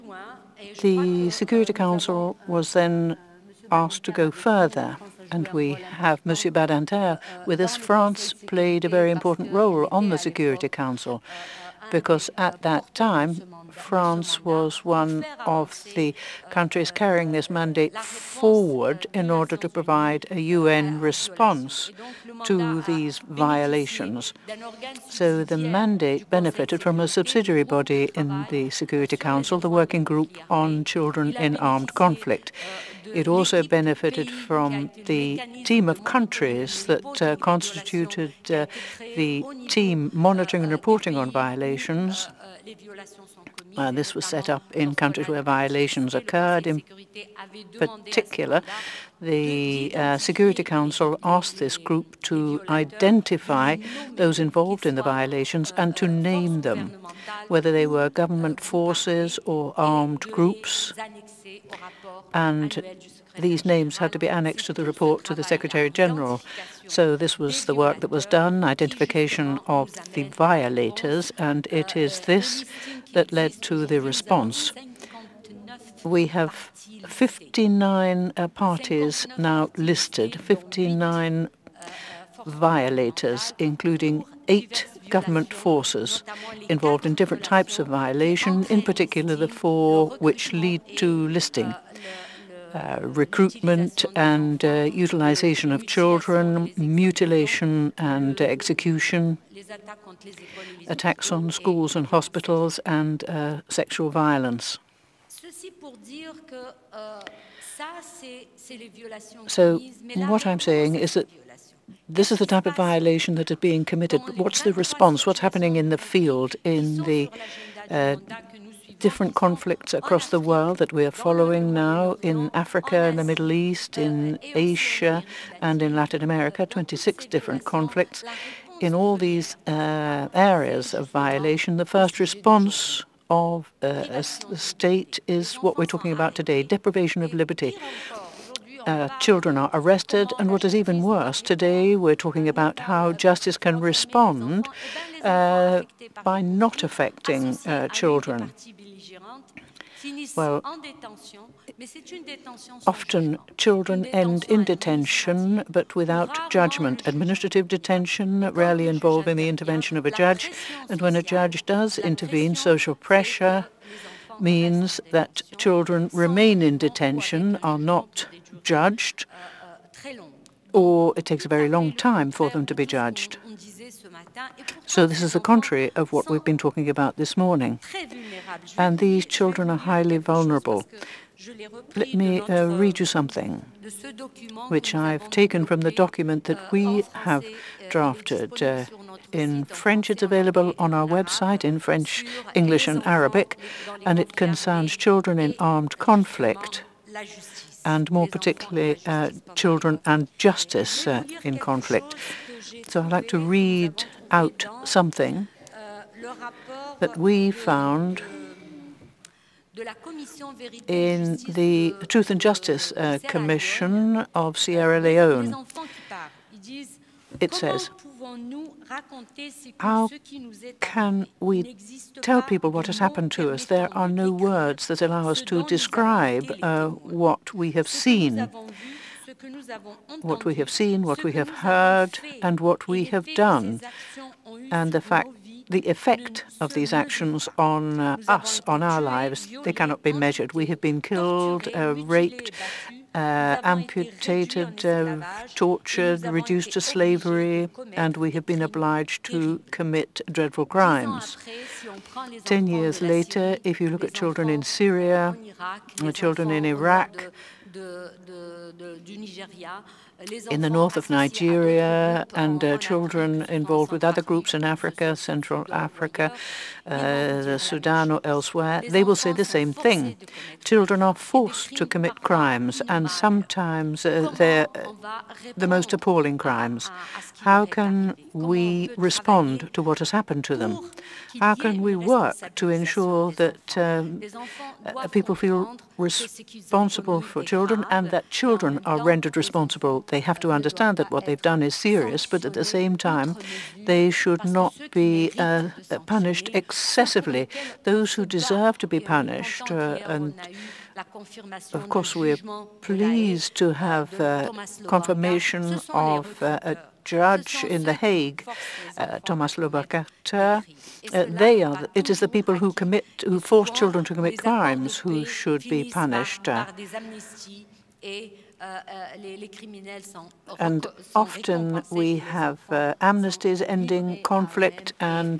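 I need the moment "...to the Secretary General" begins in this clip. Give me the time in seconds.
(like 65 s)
65 s.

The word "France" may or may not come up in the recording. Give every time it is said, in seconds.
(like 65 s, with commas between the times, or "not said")
7 s, 13 s.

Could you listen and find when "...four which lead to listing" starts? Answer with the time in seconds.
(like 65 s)
89 s.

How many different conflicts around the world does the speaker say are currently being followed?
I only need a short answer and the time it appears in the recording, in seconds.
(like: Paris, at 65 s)
26, at 126 s.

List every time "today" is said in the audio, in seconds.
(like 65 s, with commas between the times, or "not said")
136 s, 141 s.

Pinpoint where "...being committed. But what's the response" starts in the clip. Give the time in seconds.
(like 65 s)
113 s.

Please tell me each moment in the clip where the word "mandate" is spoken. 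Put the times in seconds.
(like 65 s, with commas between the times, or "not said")
17 s, 25 s.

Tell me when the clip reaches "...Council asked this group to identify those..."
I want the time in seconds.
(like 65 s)
50 s.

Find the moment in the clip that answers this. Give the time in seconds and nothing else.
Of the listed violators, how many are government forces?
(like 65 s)
84 s.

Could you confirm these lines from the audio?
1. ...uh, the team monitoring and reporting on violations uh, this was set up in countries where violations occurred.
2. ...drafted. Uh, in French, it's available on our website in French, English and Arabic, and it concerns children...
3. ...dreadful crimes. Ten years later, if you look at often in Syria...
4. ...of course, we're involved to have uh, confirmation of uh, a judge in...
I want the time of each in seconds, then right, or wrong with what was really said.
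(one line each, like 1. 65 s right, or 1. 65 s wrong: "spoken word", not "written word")
1. 38 s right
2. 187 s right
3. 250 s wrong: "children", not "often"
4. 301 s wrong: "pleased", not "involved".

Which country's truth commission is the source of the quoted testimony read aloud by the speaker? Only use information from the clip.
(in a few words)
Sierra Leone.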